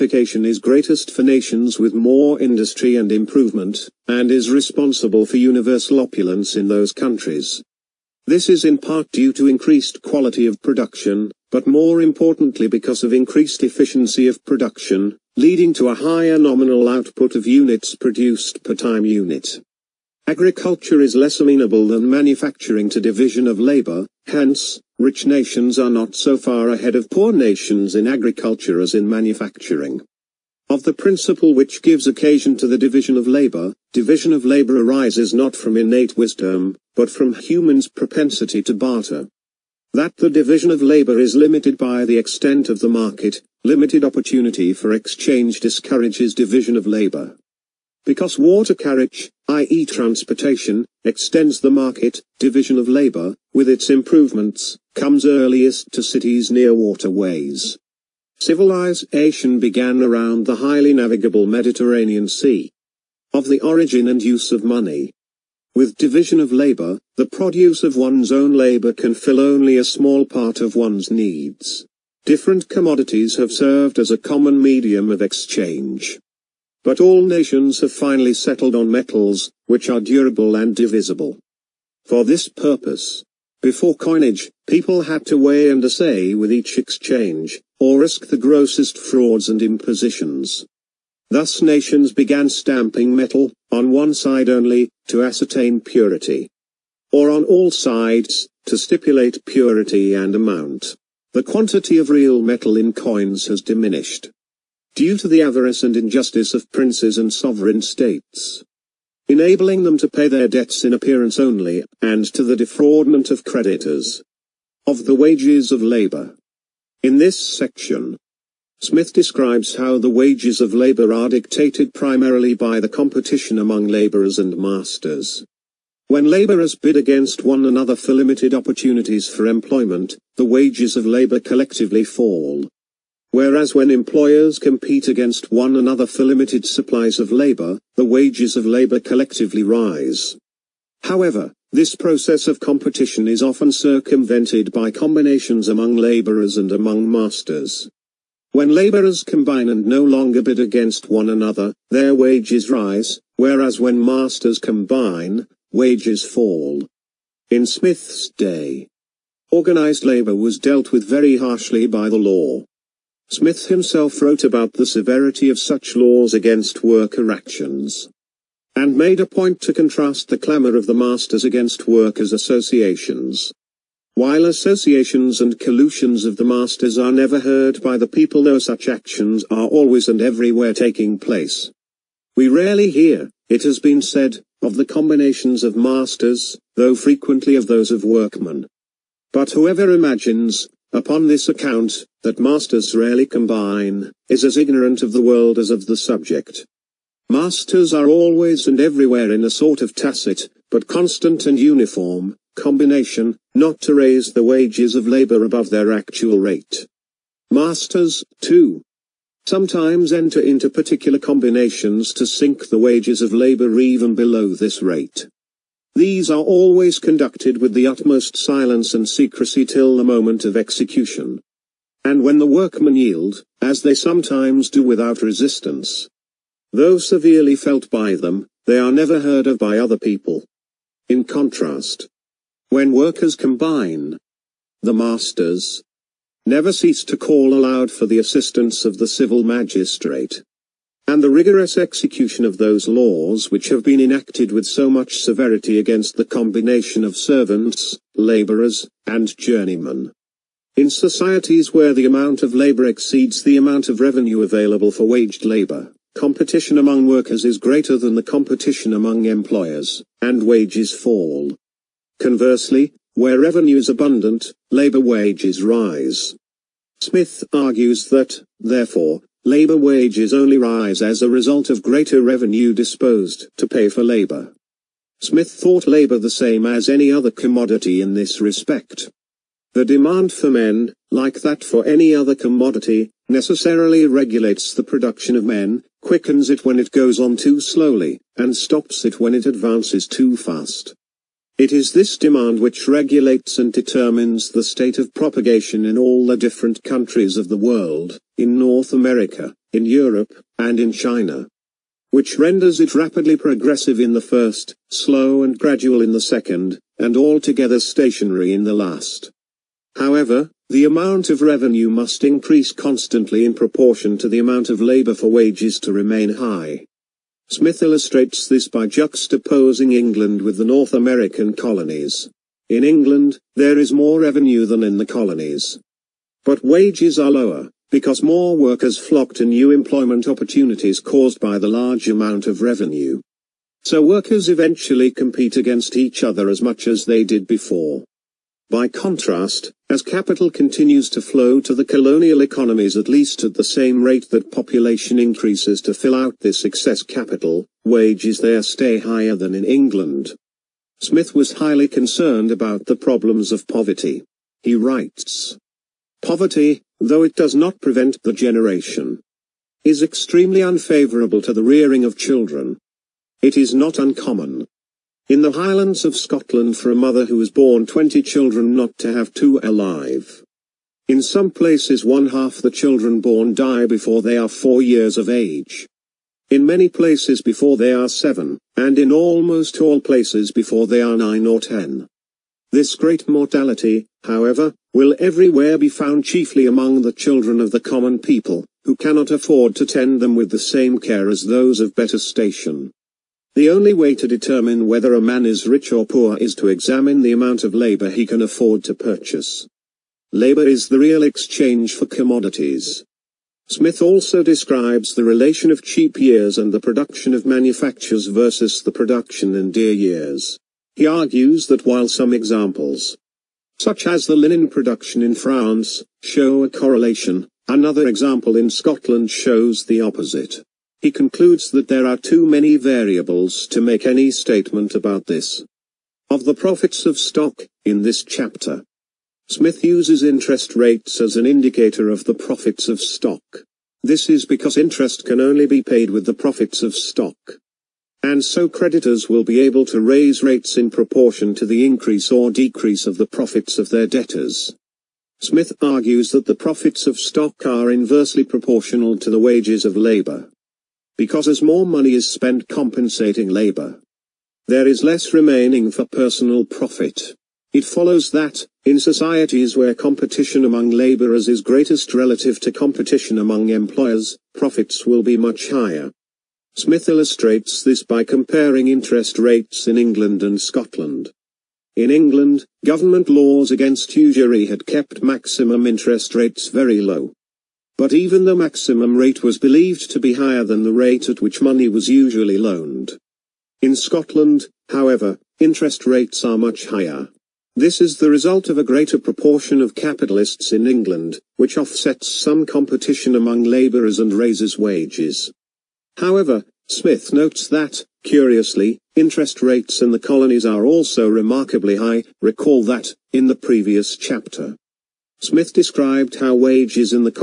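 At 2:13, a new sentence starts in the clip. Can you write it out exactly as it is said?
Whereas when employers compete against one another for limited supplies of labor, the wages of labor collectively rise.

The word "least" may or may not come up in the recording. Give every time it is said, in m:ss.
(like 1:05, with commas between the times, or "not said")
5:43.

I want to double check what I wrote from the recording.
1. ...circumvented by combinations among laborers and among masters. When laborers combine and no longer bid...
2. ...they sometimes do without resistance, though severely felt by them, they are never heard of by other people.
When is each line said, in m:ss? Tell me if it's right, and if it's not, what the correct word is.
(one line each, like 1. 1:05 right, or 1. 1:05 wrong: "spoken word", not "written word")
1. 2:23 right
2. 3:43 right.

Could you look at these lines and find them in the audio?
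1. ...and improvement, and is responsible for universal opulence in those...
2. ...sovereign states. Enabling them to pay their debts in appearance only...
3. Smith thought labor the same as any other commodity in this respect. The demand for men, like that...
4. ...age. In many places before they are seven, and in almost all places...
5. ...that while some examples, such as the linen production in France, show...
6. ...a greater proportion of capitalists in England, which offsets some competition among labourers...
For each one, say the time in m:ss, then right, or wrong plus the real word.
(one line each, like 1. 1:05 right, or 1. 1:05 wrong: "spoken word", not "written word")
1. 0:02 right
2. 1:47 right
3. 4:35 right
4. 6:15 right
5. 6:51 right
6. 8:08 right.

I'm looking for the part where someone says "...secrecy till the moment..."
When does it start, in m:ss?
3:39.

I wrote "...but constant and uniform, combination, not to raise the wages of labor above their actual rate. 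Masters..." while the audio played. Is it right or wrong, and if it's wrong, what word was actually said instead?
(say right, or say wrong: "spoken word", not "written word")
right.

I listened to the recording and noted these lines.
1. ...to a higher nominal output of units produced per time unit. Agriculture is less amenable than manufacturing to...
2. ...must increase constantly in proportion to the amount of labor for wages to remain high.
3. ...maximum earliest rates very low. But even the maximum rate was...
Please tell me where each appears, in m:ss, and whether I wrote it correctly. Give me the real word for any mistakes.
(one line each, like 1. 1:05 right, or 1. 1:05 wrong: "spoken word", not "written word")
1. 0:15 right
2. 5:11 right
3. 7:55 wrong: "interest", not "earliest".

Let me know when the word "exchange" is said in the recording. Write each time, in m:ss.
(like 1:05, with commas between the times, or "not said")
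0:44, 1:15, 1:26, 6:41.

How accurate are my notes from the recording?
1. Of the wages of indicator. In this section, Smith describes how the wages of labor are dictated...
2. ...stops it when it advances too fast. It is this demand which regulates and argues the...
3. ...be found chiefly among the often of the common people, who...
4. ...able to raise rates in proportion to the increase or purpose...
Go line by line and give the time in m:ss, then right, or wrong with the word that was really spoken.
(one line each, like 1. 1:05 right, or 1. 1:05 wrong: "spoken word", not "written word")
1. 1:54 wrong: "labor", not "indicator"
2. 4:48 wrong: "determines", not "argues"
3. 6:25 wrong: "children", not "often"
4. 7:19 wrong: "decrease", not "purpose".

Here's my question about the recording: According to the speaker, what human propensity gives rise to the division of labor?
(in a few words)
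propensity to barter.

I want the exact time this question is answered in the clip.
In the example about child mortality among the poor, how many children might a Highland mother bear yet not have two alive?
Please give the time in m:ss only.
6:07.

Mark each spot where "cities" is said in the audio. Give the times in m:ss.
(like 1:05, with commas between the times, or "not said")
0:56.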